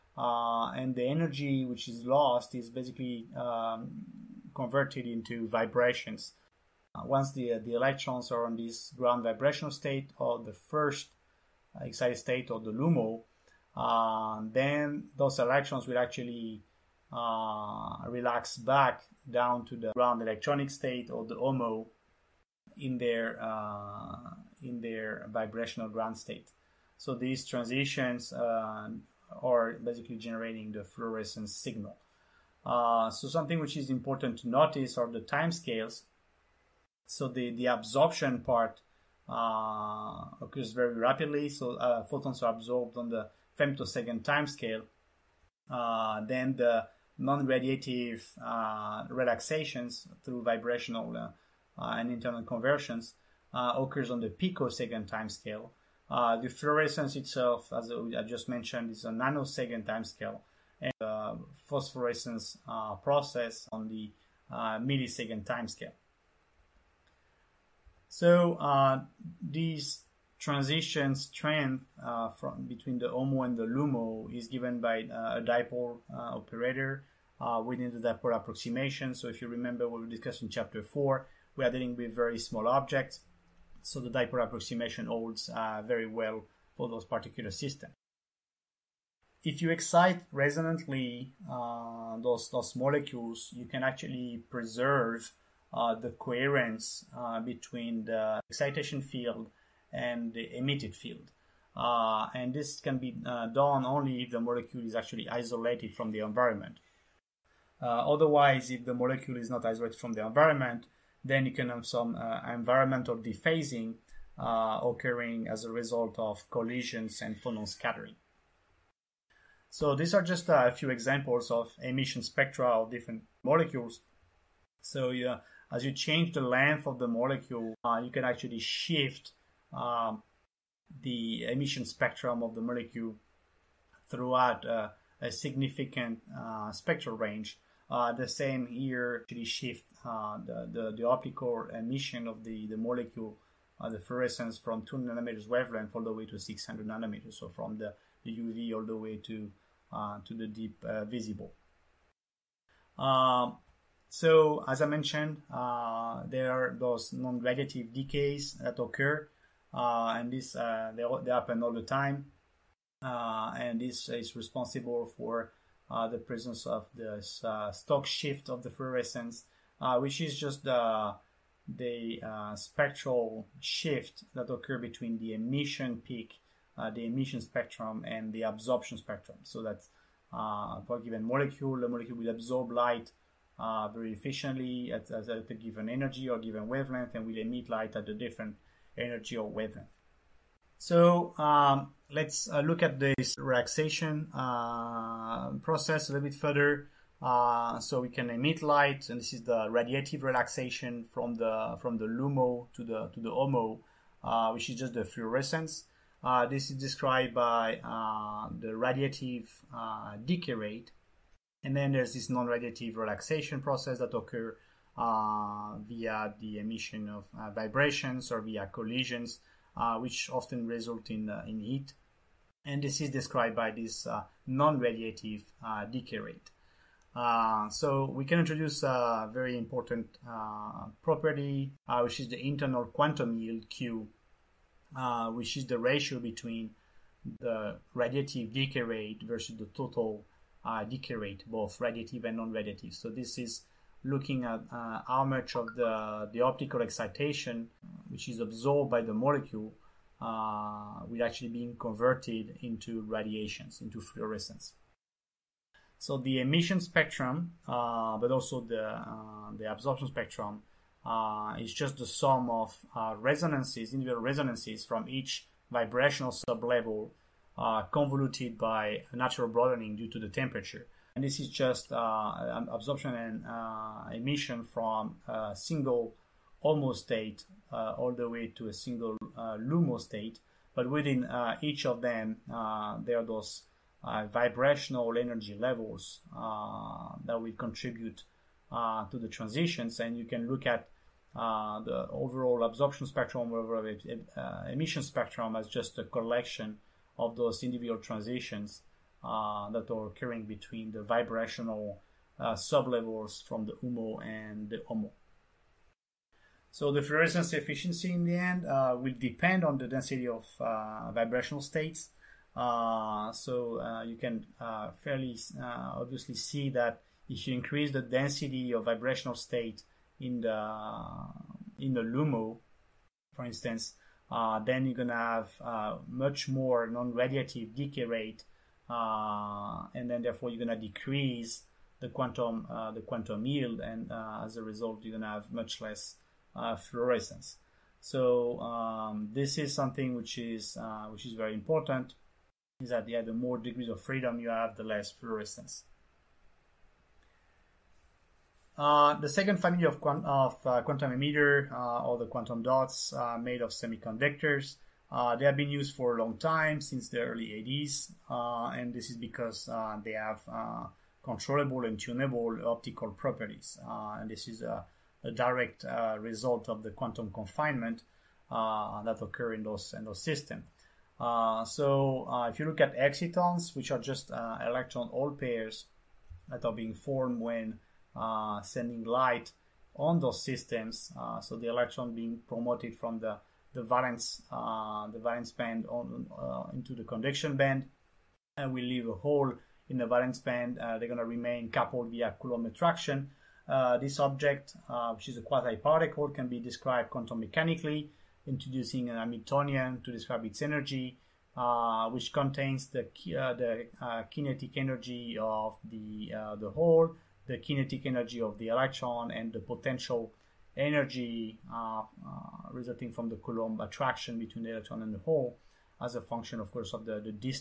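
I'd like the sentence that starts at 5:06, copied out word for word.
So the fluorescence efficiency in the end uh, will depend on the density of uh, vibrational states.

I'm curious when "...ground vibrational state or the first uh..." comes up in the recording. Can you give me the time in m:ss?
0:08.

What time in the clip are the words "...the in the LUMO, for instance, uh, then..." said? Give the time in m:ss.
5:20.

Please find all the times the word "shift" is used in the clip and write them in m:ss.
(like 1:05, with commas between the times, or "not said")
2:08, 2:19, 2:48, 2:53.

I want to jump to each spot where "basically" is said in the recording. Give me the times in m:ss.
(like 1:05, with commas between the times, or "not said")
0:02, 0:29.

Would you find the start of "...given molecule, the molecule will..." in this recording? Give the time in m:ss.
3:01.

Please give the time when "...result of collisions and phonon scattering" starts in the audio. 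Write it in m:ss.
1:55.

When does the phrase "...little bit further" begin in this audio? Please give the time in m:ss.
3:16.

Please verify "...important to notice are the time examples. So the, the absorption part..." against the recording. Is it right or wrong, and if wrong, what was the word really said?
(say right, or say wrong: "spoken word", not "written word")
wrong: "scales", not "examples".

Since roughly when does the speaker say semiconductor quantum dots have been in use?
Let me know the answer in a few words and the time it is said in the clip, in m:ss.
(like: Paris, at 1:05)
early 80s, at 5:57.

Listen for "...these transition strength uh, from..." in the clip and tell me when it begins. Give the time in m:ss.
1:09.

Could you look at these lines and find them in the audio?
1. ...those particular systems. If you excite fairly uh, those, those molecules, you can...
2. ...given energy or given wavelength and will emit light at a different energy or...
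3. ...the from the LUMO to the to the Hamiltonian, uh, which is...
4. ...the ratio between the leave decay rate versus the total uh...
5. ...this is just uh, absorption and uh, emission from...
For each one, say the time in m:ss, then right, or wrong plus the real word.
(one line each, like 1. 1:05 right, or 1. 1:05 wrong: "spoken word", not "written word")
1. 1:26 wrong: "resonantly", not "fairly"
2. 3:05 right
3. 3:21 wrong: "HOMO", not "Hamiltonian"
4. 3:55 wrong: "radiative", not "leave"
5. 4:31 right.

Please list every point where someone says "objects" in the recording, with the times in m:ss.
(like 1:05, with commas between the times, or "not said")
1:22, 6:34.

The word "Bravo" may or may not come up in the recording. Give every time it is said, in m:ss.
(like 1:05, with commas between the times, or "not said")
not said.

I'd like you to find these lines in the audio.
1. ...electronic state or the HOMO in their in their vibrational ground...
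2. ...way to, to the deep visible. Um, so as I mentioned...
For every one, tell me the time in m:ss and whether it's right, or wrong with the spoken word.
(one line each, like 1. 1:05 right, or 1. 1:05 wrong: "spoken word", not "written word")
1. 0:20 right
2. 2:28 right.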